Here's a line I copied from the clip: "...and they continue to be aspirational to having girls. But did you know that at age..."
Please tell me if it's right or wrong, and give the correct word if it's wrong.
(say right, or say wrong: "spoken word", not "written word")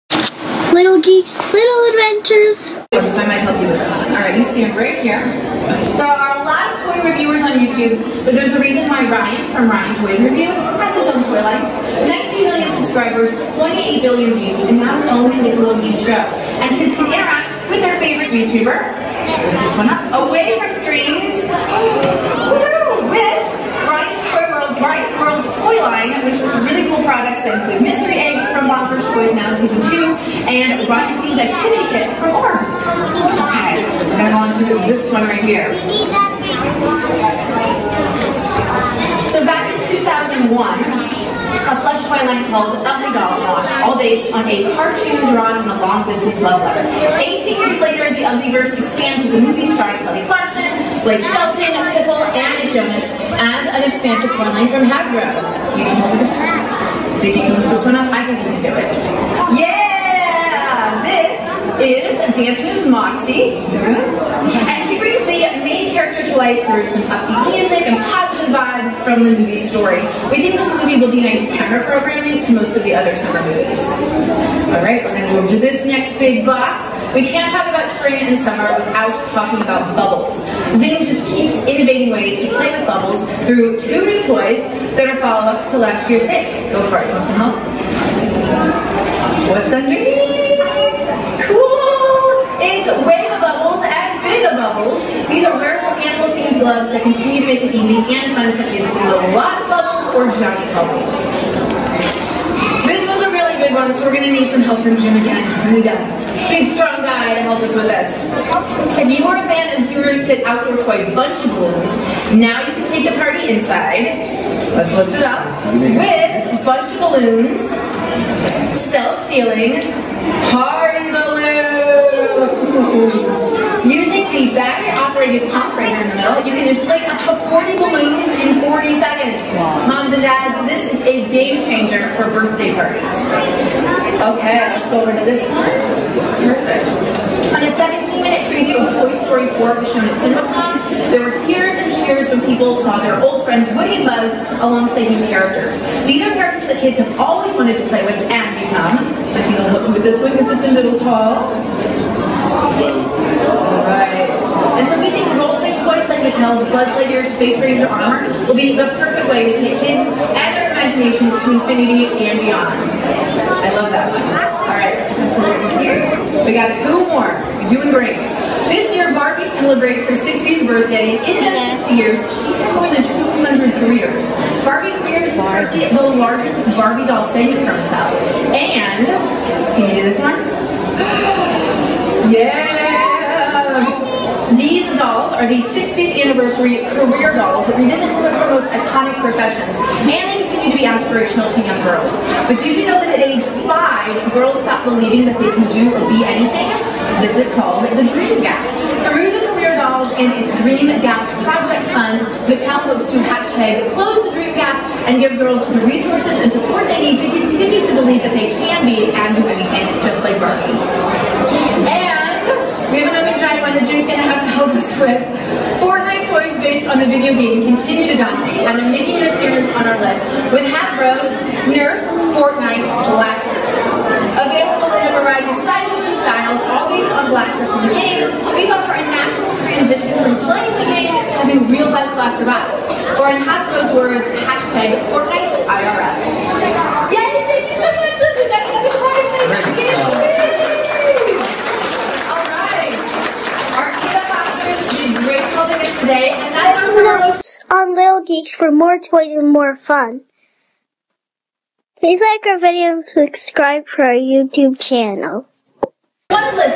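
wrong: "young", not "having".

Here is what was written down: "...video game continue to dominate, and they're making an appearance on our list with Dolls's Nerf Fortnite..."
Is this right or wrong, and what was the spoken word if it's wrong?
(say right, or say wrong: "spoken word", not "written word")
wrong: "Hasbro", not "Dolls".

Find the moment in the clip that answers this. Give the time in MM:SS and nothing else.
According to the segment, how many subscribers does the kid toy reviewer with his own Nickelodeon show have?
00:12.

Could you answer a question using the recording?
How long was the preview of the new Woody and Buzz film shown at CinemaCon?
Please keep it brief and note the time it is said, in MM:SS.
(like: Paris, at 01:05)
17 minutes, at 02:17.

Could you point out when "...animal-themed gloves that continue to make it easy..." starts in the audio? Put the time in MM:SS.
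01:35.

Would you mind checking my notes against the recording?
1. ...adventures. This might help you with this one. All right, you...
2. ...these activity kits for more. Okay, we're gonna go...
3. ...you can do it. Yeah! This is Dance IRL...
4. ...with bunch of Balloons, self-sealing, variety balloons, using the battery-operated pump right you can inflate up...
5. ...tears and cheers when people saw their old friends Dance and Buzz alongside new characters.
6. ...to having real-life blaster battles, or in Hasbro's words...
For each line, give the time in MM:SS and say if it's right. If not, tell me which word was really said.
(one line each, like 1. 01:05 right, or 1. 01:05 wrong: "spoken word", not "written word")
1. 00:01 right
2. 00:31 right
3. 00:58 wrong: "Moves", not "IRL"
4. 01:55 wrong: "party", not "variety"
5. 02:21 wrong: "Woody", not "Dance"
6. 03:51 right.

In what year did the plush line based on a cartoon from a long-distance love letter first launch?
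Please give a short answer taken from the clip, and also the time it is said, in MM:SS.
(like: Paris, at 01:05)
2001, at 00:39.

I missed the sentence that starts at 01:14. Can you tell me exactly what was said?
Alright, we're gonna go to this next big box.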